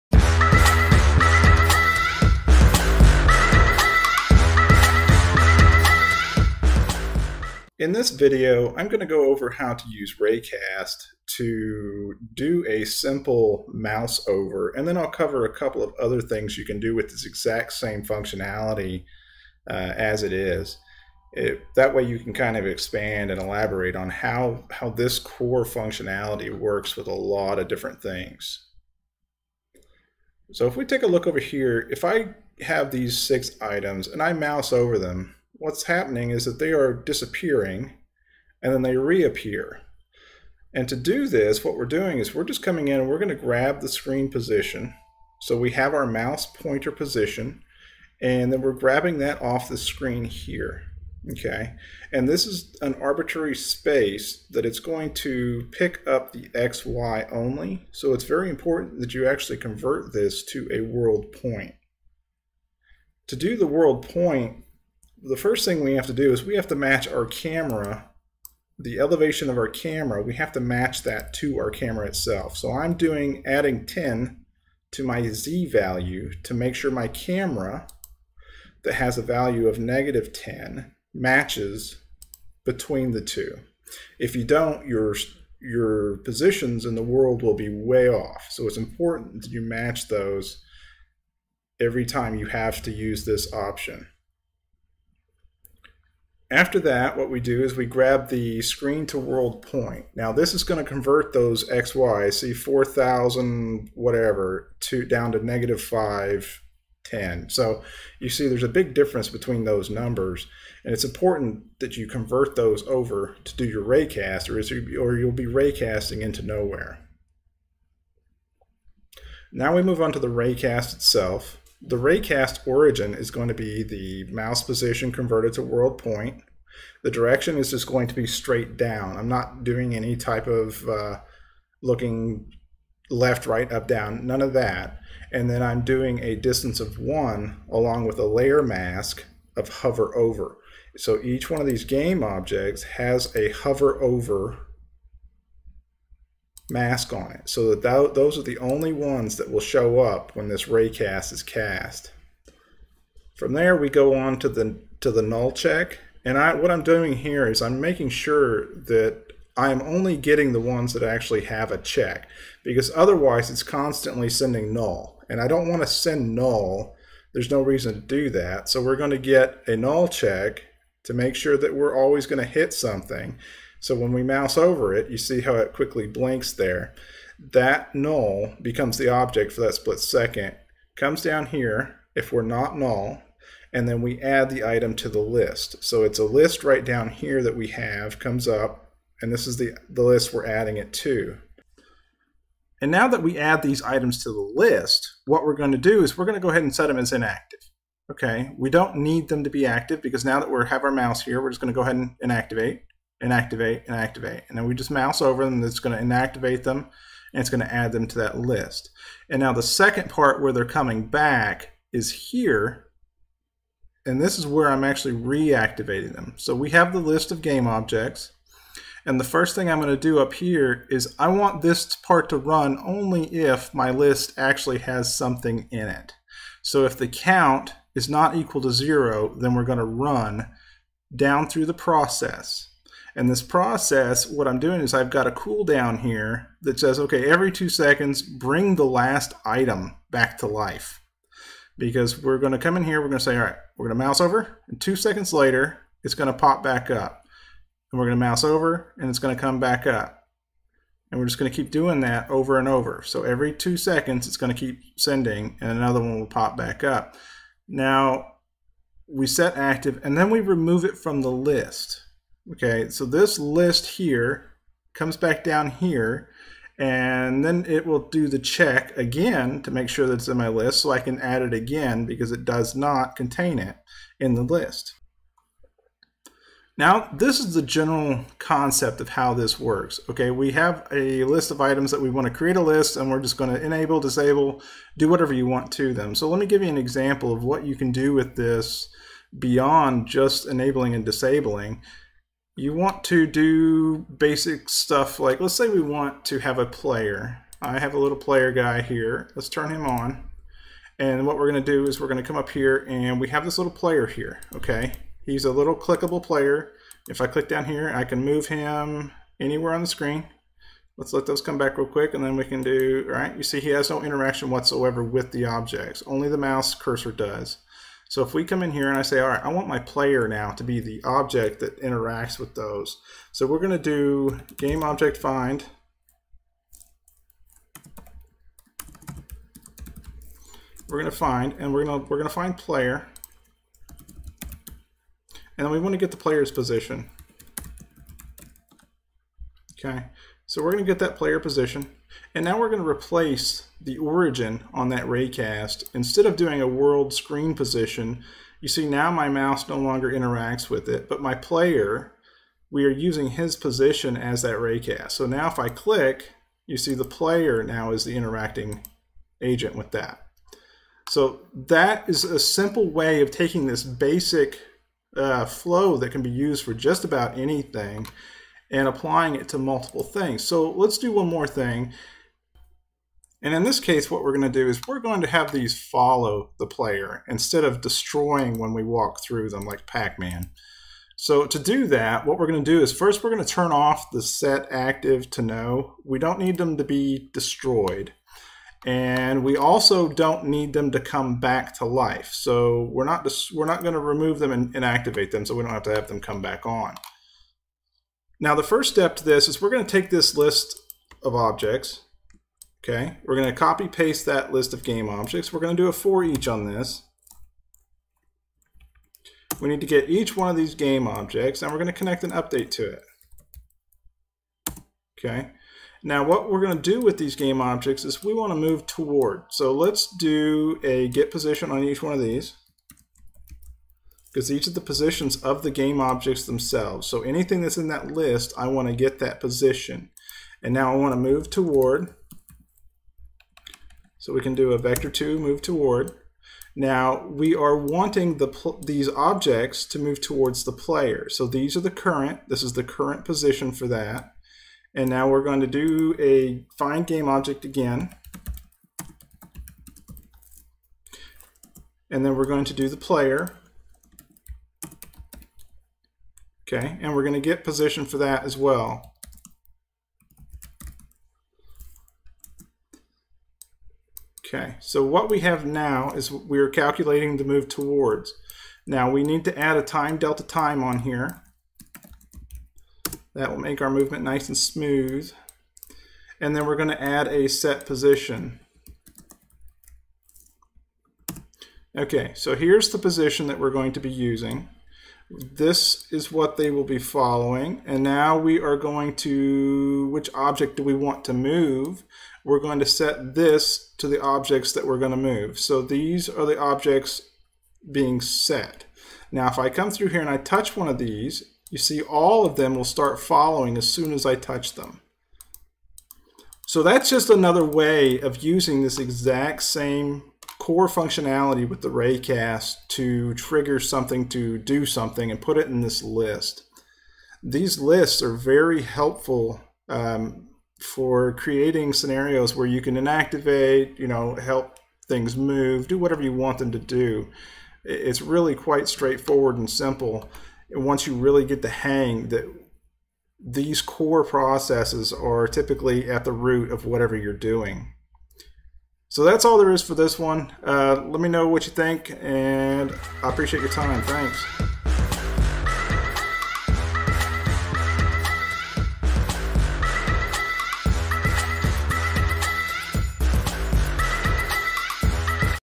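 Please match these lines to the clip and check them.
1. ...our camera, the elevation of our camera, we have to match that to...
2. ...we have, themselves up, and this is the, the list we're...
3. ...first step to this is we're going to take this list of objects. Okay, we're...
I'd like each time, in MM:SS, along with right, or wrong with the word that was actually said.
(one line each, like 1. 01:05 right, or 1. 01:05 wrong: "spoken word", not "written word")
1. 01:07 right
2. 03:07 wrong: "comes", not "themselves"
3. 06:38 right.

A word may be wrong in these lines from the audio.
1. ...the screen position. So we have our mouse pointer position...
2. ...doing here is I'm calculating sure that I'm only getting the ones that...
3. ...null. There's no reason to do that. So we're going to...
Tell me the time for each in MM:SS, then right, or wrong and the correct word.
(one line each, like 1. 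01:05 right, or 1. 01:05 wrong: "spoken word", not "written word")
1. 00:43 right
2. 02:36 wrong: "making", not "calculating"
3. 02:46 right.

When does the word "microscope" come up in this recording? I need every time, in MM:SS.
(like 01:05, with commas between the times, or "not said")
not said.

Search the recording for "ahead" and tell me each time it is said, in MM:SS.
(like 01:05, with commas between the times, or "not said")
03:16, 03:21.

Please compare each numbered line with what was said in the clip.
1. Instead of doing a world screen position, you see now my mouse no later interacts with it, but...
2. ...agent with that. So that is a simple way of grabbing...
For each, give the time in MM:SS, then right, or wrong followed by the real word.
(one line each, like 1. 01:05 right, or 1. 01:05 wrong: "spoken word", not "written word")
1. 05:45 wrong: "longer", not "later"
2. 05:59 wrong: "taking", not "grabbing".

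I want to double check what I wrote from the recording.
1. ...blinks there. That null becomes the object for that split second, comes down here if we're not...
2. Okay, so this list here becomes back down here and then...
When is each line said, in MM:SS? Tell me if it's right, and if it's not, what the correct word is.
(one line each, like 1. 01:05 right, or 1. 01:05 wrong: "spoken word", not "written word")
1. 02:56 right
2. 04:22 wrong: "comes", not "becomes".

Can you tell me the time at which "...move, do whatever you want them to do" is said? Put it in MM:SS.
08:45.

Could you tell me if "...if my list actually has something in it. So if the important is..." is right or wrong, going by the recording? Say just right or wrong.
wrong.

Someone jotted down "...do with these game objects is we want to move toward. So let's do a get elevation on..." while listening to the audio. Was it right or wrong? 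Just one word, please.
wrong.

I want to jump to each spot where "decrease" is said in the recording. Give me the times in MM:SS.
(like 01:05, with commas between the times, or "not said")
not said.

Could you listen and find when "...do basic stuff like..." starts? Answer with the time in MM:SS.
04:53.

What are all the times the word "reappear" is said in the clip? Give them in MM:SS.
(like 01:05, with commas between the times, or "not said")
00:38.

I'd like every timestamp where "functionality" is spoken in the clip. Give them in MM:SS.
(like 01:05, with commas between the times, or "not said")
00:18, 00:25, 08:30.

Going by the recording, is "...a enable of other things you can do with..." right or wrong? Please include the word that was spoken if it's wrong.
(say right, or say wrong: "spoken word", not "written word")
wrong: "couple", not "enable".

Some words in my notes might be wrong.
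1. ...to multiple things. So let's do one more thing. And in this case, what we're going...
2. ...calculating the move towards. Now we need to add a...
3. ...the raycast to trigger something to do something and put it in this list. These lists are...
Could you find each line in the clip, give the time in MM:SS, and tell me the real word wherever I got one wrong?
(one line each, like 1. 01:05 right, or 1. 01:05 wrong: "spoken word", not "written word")
1. 06:09 right
2. 07:46 right
3. 08:31 right.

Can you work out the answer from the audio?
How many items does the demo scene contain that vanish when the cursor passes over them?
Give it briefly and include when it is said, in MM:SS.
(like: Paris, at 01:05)
6, at 00:33.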